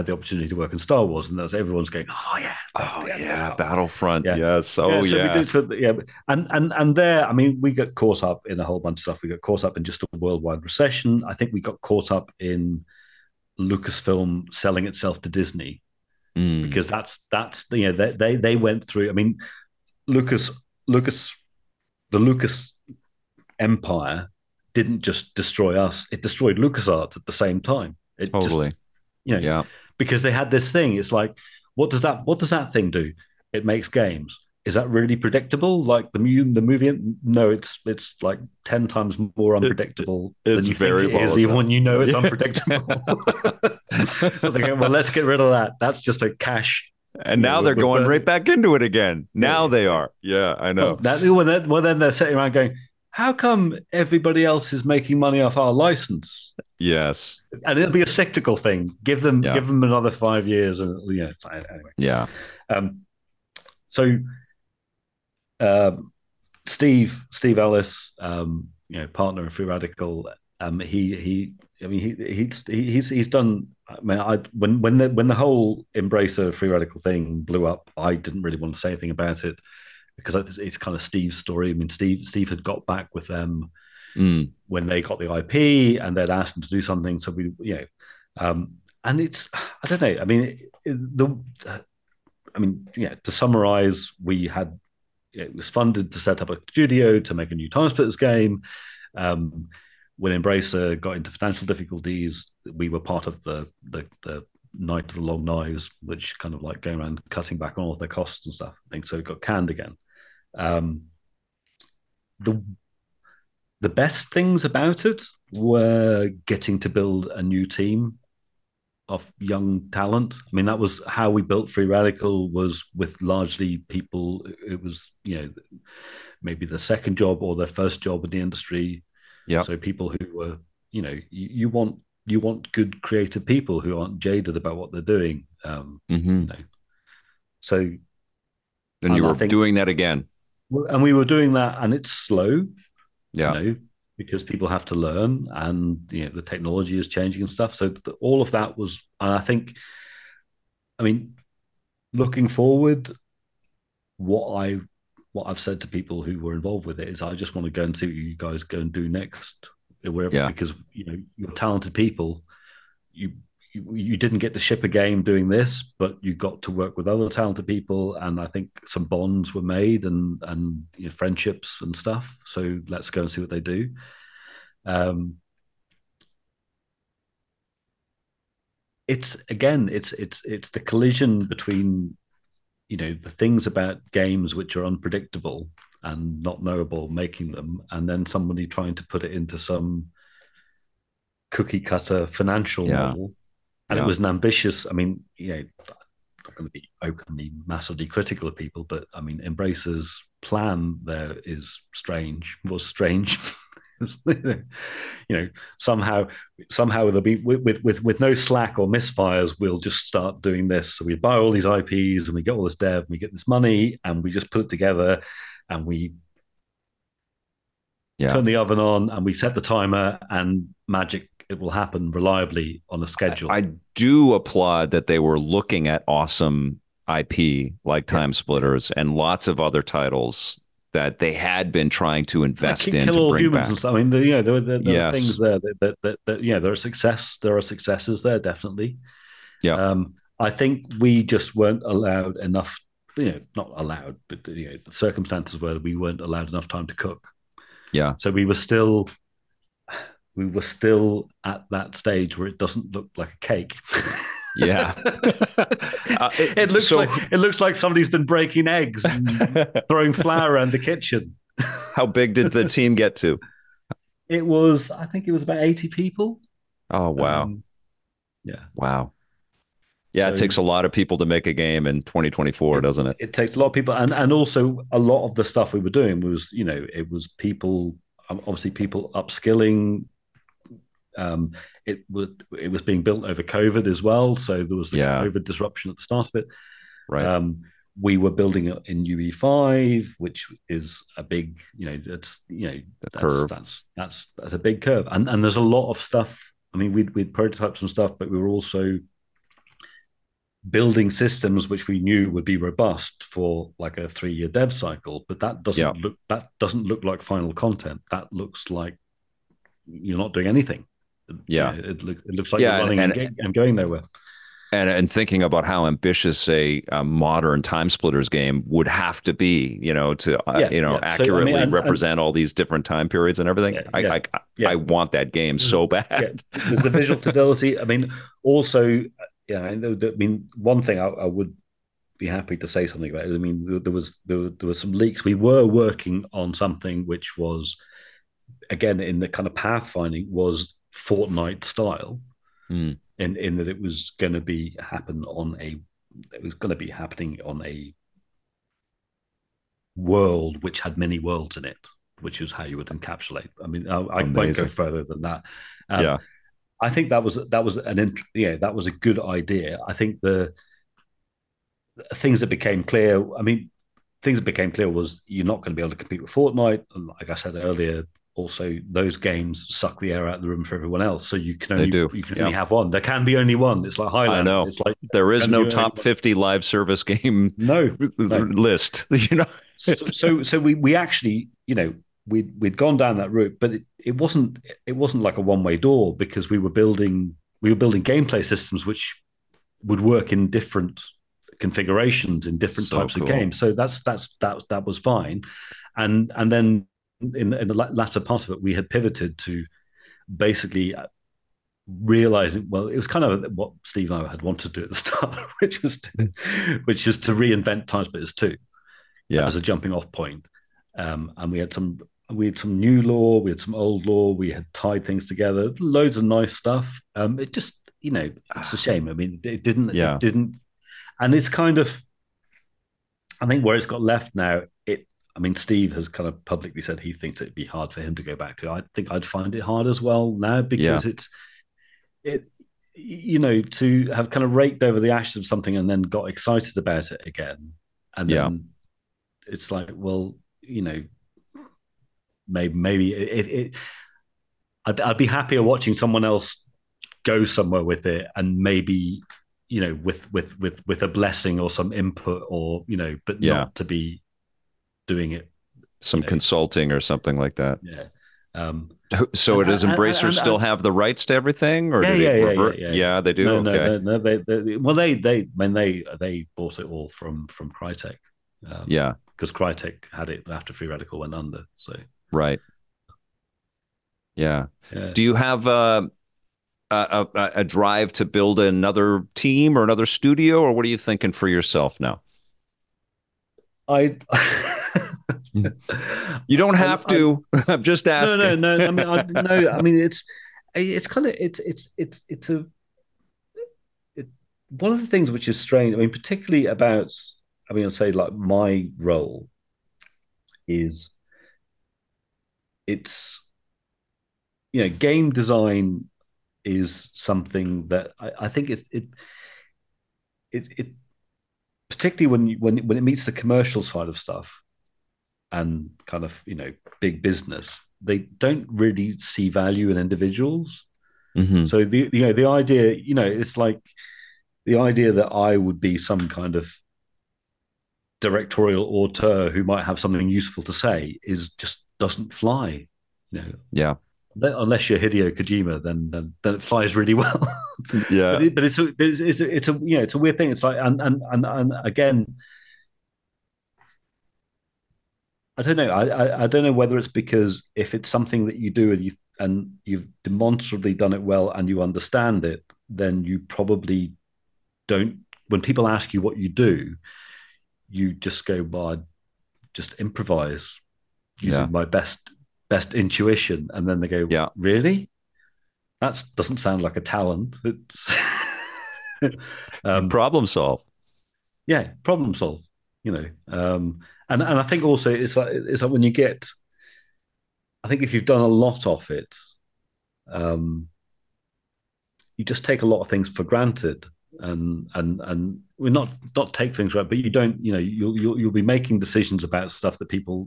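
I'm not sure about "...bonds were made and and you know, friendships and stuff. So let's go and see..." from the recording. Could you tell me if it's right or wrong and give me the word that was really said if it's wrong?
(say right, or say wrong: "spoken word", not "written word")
right.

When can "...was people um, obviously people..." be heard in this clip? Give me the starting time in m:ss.
4:37.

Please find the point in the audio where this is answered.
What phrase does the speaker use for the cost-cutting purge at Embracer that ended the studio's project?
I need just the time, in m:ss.
1:44.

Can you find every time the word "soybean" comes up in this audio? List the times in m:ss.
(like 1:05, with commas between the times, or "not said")
not said.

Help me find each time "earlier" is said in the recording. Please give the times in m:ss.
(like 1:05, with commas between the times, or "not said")
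6:07.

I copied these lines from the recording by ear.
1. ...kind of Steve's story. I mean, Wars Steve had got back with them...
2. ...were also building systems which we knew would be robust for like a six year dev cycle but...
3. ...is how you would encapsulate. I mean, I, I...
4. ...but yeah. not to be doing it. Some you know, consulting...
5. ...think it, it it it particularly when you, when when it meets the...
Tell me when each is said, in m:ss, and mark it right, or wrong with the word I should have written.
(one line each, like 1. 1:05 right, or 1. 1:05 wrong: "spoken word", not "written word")
1. 1:20 wrong: "Steve", not "Wars"
2. 4:58 wrong: "three", not "six"
3. 5:52 right
4. 7:33 right
5. 8:28 right.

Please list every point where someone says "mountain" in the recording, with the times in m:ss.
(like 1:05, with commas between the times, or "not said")
not said.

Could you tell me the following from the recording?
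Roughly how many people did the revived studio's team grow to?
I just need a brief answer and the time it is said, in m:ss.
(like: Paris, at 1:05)
80, at 4:25.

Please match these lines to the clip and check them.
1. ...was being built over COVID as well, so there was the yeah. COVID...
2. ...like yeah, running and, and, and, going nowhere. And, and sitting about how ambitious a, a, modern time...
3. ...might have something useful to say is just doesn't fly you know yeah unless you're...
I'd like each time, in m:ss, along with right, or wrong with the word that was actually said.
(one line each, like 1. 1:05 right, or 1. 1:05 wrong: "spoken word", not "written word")
1. 4:42 right
2. 5:12 wrong: "thinking", not "sitting"
3. 8:49 right.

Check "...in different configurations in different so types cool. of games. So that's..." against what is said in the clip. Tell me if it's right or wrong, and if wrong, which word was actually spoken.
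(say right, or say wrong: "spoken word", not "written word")
right.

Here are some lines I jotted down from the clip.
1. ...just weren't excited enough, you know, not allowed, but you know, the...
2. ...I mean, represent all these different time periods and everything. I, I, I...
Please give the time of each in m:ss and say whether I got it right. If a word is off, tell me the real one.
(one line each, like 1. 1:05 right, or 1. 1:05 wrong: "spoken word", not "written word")
1. 4:01 wrong: "allowed", not "excited"
2. 5:21 right.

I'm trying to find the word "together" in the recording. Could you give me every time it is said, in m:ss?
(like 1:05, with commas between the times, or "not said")
3:34, 6:55.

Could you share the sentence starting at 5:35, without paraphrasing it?
We were working on something which was, again, in the kind of pathfinding was Fortnite style, mm.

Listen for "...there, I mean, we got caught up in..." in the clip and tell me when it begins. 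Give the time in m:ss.
0:06.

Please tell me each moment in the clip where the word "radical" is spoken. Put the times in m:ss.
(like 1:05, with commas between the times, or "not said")
1:09, 1:16, 2:01, 7:50.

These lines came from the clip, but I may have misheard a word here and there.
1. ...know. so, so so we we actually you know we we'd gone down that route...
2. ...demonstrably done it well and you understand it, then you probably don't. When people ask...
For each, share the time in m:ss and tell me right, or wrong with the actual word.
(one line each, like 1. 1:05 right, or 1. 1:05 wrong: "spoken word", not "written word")
1. 6:19 right
2. 9:10 right.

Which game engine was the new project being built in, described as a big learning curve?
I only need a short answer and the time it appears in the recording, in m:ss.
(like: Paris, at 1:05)
UE5, at 4:49.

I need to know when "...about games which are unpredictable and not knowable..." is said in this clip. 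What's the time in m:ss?
3:03.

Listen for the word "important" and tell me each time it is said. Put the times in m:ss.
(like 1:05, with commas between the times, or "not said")
not said.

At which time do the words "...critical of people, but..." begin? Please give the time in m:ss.
3:18.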